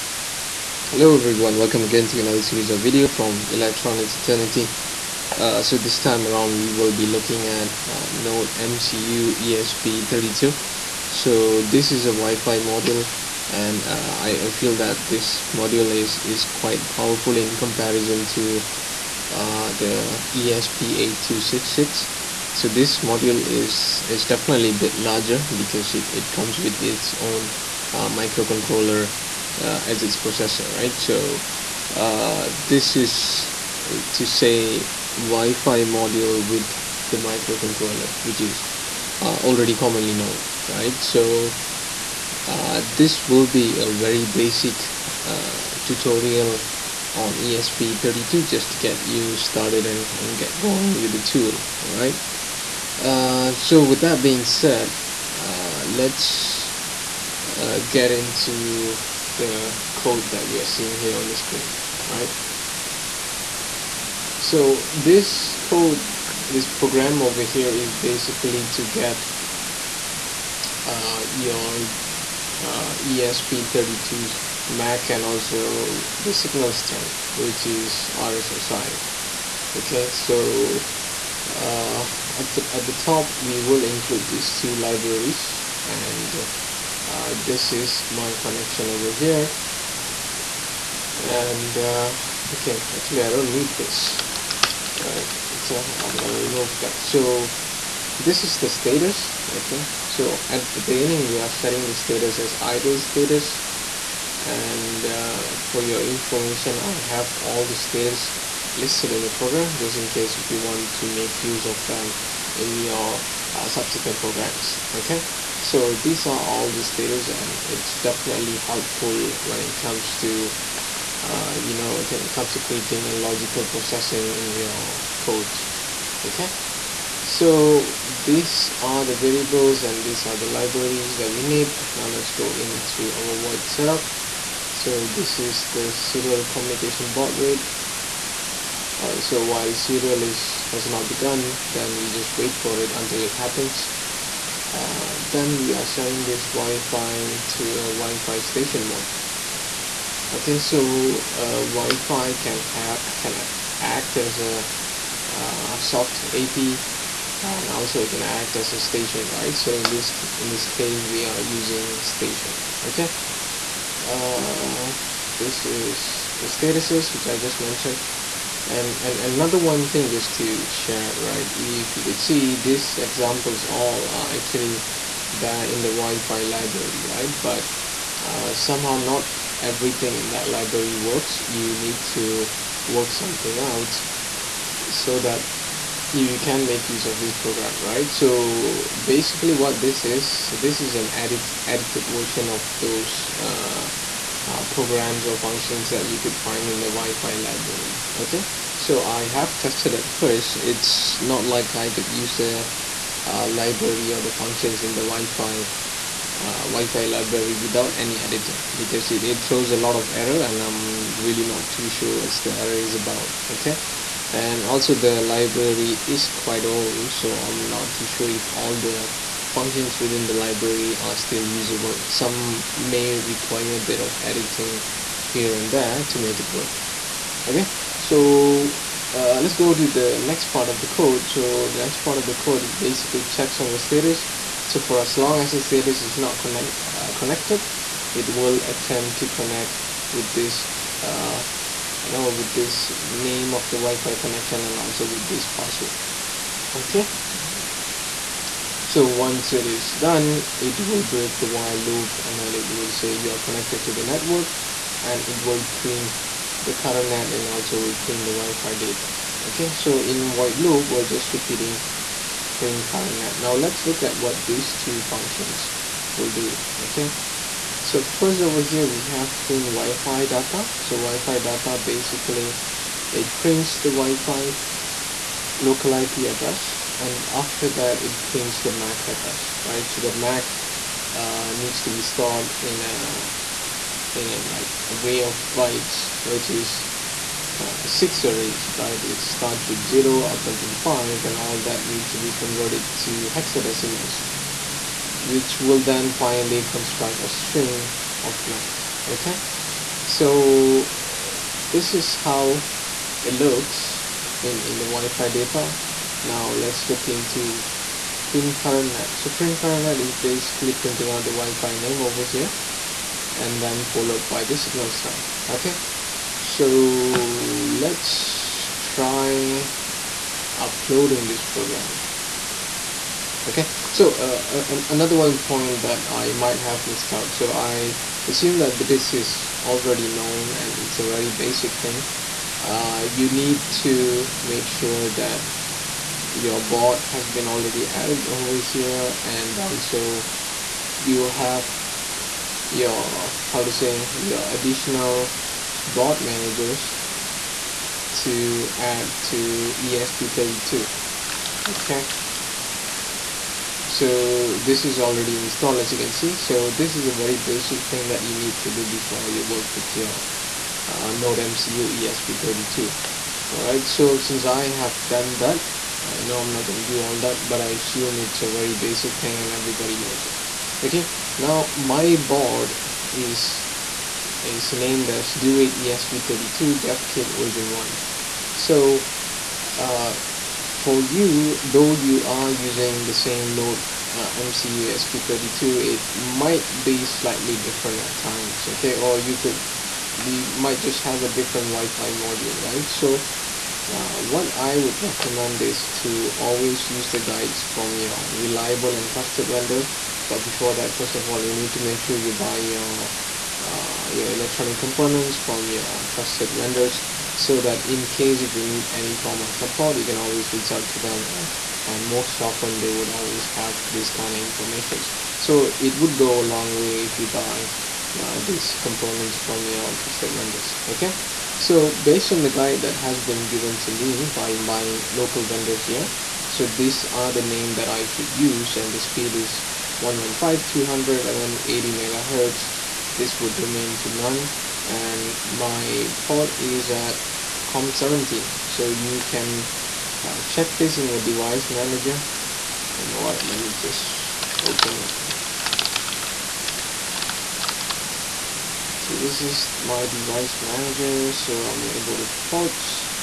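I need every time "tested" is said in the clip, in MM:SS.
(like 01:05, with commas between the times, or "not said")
03:19.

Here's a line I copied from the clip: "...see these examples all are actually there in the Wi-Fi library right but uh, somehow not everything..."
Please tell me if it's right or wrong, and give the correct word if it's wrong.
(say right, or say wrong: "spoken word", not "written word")
right.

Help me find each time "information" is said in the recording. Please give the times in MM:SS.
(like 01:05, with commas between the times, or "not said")
01:46, 06:54.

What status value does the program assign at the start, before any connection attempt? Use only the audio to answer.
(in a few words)
idle status.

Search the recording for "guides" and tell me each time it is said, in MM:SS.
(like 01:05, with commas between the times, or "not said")
06:37, 07:02.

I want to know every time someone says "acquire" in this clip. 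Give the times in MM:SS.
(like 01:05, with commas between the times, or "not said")
not said.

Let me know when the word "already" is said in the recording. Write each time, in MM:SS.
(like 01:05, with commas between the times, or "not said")
00:39, 05:29, 05:37, 05:54.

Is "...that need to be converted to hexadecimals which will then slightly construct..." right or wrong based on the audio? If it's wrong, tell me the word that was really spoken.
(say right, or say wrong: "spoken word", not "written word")
wrong: "finally", not "slightly".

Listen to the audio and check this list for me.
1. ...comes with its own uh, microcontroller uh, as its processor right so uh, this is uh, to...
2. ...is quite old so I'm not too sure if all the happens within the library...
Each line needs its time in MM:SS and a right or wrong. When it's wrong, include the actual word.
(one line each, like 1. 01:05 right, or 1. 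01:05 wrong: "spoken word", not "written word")
1. 00:26 right
2. 03:36 wrong: "functions", not "happens".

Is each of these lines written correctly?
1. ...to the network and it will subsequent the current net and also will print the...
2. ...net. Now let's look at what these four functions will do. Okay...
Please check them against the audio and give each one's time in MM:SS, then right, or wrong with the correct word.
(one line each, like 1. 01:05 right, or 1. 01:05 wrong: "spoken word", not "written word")
1. 04:13 wrong: "print", not "subsequent"
2. 04:23 wrong: "two", not "four".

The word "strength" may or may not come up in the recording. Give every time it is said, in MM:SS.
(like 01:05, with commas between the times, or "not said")
01:16, 05:14.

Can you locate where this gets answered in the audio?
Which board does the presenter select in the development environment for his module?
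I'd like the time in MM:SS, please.
06:15.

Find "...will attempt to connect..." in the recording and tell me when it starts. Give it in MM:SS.
03:58.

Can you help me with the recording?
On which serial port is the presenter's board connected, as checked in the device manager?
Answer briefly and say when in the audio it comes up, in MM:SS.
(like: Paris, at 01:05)
COM17, at 07:17.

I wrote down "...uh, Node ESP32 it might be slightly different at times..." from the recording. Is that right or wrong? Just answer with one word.
wrong.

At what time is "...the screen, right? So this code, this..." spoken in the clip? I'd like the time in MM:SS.
01:01.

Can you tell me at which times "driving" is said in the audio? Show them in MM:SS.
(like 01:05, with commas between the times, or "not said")
not said.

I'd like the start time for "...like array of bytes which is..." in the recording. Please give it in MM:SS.
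04:44.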